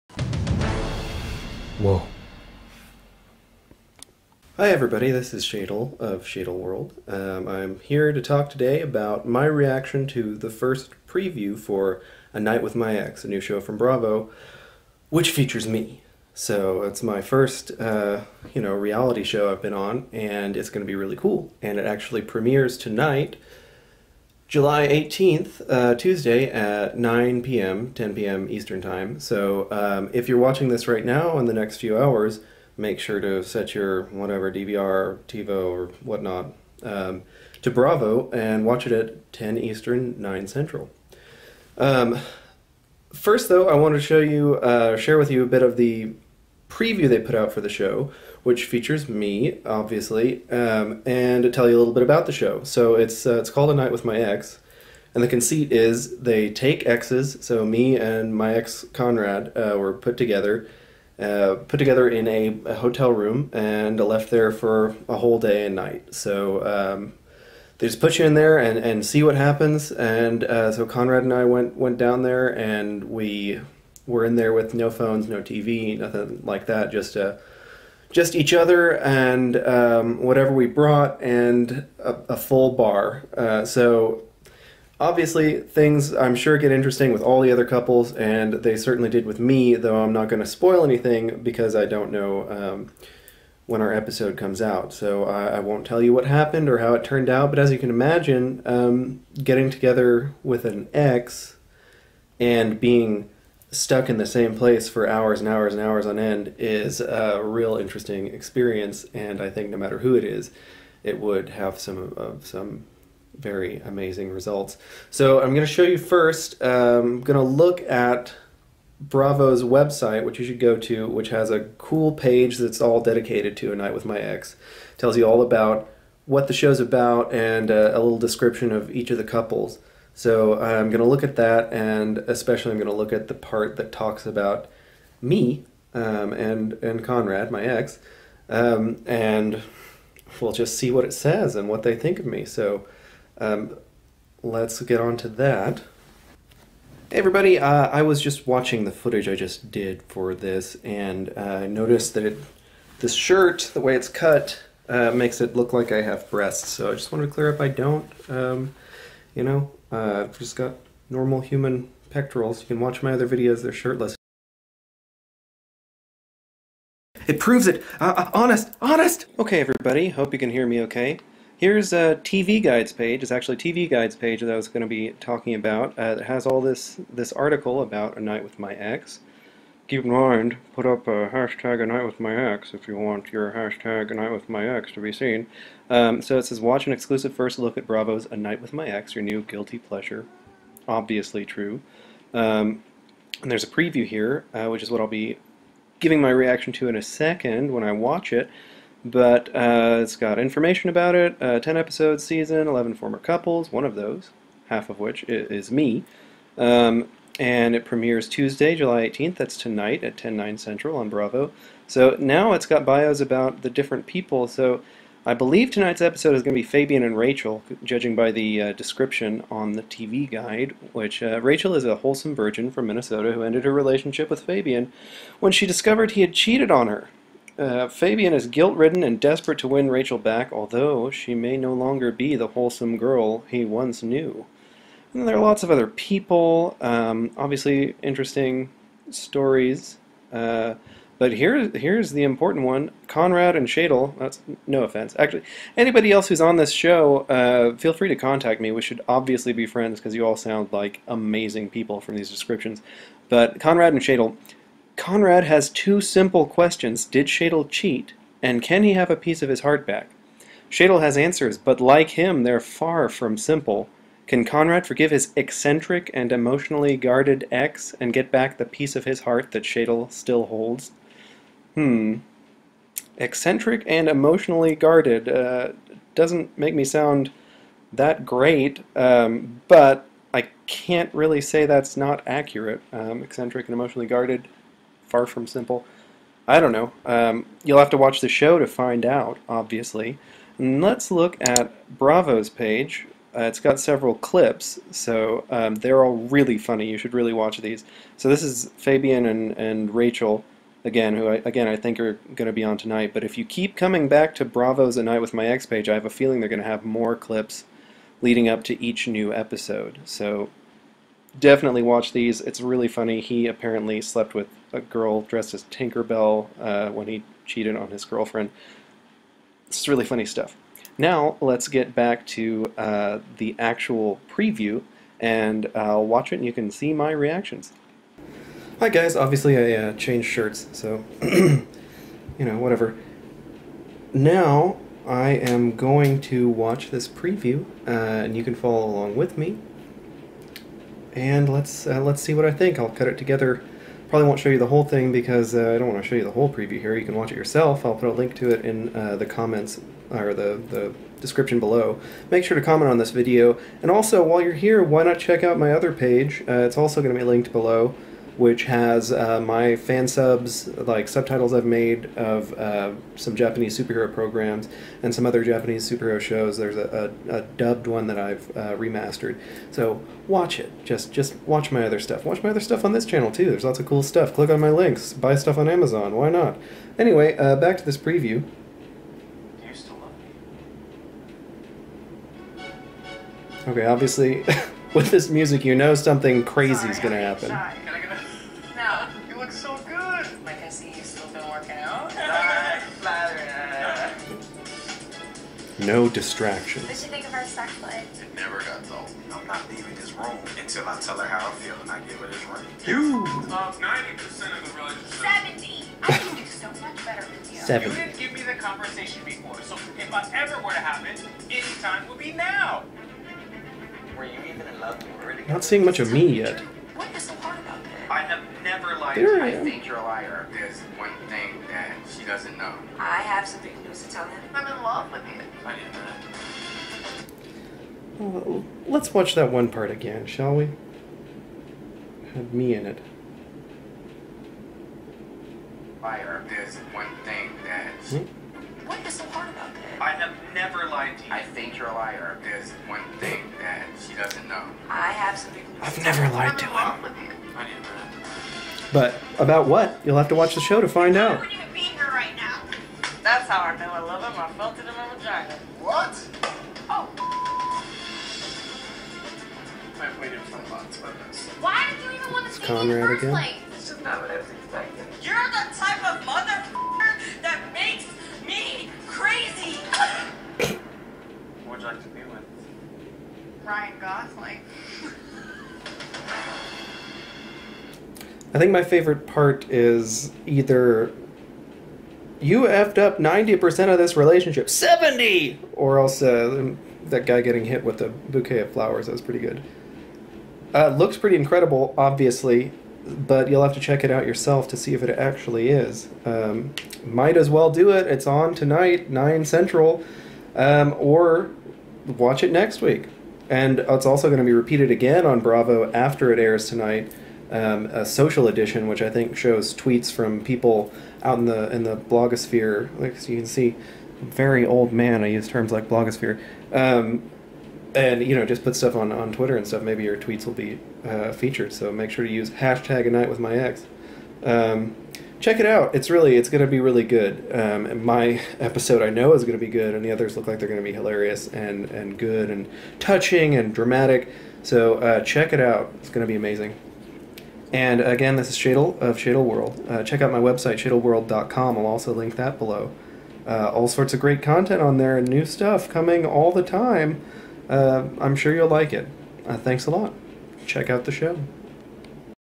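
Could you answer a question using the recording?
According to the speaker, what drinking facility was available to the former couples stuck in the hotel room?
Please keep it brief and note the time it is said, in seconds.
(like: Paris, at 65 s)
a full bar, at 82 s.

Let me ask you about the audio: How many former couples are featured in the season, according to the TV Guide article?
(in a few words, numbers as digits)
11.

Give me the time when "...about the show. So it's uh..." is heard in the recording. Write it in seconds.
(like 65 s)
52 s.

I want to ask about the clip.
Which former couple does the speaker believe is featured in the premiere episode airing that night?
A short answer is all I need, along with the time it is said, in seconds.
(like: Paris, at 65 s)
Fabian and Rachel, at 216 s.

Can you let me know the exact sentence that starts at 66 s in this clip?
Um, they just put you in there and, and see what happens.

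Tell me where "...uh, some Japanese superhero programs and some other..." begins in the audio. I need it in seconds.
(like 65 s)
362 s.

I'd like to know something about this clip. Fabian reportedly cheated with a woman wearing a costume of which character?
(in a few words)
Tinkerbell.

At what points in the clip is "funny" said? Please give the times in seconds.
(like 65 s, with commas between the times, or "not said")
296 s, 312 s, 320 s.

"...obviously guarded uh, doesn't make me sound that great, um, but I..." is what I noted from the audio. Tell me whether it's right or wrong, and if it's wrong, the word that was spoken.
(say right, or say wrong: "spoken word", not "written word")
wrong: "emotionally", not "obviously".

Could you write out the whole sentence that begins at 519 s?
Maybe your tweets will be uh, featured.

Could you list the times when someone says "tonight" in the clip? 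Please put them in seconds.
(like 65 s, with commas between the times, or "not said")
22 s, 209 s, 215 s, 302 s, 498 s, 506 s.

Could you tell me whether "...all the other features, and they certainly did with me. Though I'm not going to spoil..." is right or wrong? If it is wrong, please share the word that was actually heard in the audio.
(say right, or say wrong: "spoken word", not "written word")
wrong: "couples", not "features".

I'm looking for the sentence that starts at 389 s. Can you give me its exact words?
I can see you still been working out.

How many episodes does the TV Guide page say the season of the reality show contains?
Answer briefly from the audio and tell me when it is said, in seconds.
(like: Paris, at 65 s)
10, at 201 s.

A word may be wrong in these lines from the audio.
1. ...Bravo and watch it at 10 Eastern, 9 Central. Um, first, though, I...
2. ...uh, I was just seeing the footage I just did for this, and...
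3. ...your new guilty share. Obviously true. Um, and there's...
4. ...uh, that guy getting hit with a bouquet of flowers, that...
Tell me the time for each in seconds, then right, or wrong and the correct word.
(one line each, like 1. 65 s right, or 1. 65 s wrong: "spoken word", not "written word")
1. 37 s right
2. 147 s wrong: "watching", not "seeing"
3. 189 s wrong: "pleasure", not "share"
4. 486 s right.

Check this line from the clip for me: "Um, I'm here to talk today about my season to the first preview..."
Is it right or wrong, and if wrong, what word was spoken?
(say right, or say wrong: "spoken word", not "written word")
wrong: "reaction", not "season".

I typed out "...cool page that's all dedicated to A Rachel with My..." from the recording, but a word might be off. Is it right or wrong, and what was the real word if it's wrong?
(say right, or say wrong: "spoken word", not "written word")
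wrong: "Night", not "Rachel".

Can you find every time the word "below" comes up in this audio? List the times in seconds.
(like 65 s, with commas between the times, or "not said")
351 s, 357 s, 542 s.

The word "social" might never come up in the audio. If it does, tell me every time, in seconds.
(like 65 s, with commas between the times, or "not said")
508 s.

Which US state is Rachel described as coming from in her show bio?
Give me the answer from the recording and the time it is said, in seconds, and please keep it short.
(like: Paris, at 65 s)
Minnesota, at 222 s.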